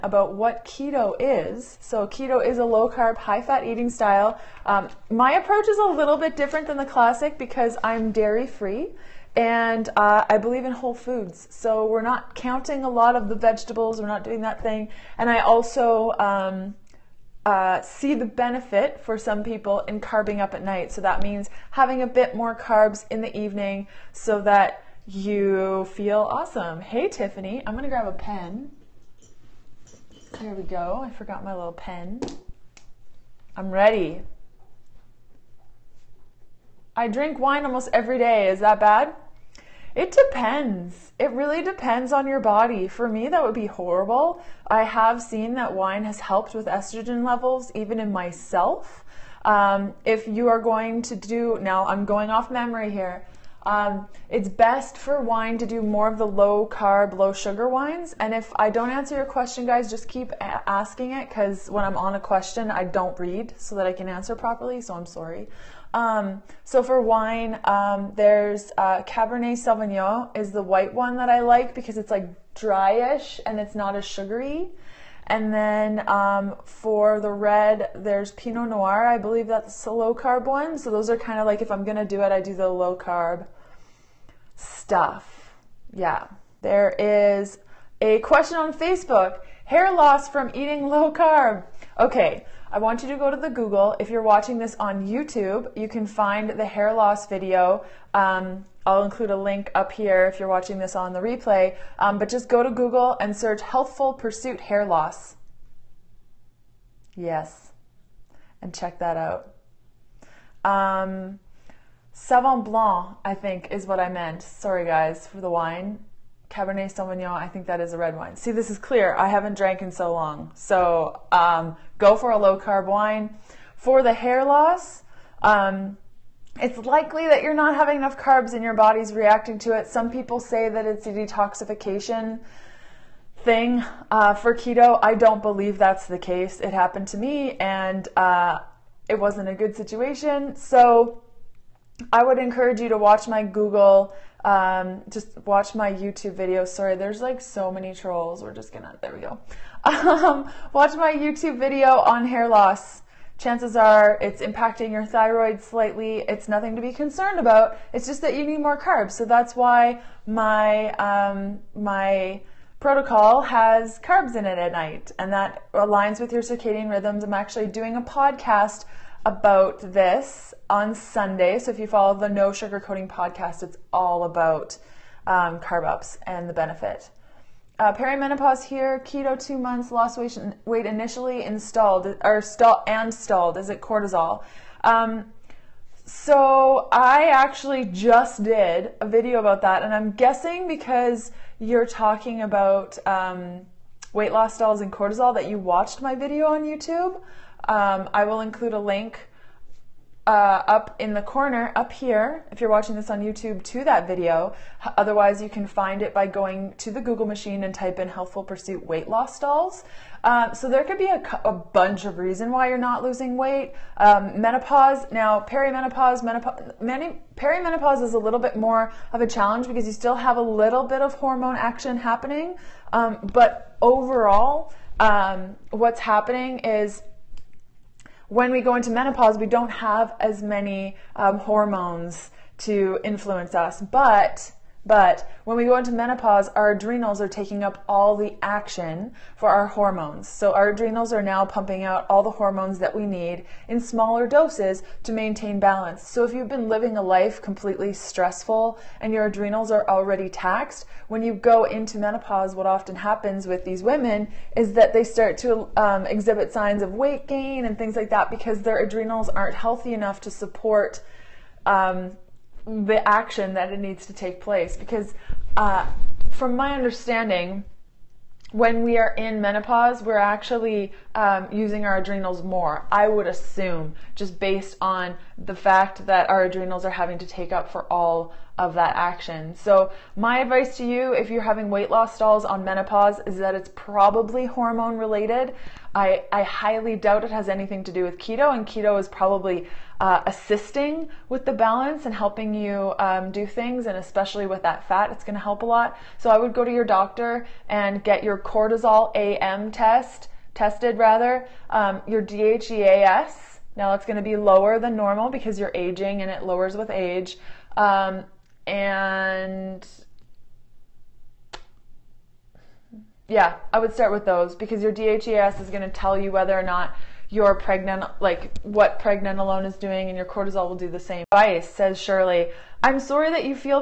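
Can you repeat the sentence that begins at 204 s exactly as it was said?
Otherwise, you can find it by going to the Google machine and type in Healthful Pursuit weight loss dolls.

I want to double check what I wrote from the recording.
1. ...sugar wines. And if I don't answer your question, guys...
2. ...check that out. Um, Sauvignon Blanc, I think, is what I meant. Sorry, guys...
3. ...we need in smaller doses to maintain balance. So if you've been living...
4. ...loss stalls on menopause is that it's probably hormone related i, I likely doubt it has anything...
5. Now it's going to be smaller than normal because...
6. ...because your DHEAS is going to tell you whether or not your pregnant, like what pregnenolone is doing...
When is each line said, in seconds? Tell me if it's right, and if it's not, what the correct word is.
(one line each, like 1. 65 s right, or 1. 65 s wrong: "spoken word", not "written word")
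1. 57 s right
2. 108 s right
3. 242 s right
4. 281 s wrong: "highly", not "likely"
5. 303 s wrong: "lower", not "smaller"
6. 314 s right.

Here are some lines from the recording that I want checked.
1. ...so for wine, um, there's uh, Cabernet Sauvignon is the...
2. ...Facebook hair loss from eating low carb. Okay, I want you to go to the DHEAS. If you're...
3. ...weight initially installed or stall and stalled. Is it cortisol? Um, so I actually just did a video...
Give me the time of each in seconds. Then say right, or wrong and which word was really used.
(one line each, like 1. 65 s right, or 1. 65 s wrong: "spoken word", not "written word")
1. 66 s right
2. 88 s wrong: "Google", not "DHEAS"
3. 180 s right.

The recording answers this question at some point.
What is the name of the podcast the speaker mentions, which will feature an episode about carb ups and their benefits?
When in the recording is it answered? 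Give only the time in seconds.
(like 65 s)
172 s.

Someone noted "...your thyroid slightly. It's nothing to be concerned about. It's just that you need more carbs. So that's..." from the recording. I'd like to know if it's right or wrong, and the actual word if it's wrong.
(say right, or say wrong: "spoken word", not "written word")
right.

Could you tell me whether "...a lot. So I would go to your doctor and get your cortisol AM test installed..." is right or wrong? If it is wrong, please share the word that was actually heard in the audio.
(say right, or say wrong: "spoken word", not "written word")
wrong: "tested", not "installed".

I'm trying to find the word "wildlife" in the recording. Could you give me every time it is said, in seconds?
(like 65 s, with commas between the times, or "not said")
not said.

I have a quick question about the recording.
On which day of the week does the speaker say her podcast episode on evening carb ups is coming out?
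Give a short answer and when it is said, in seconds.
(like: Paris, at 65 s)
Sunday, at 170 s.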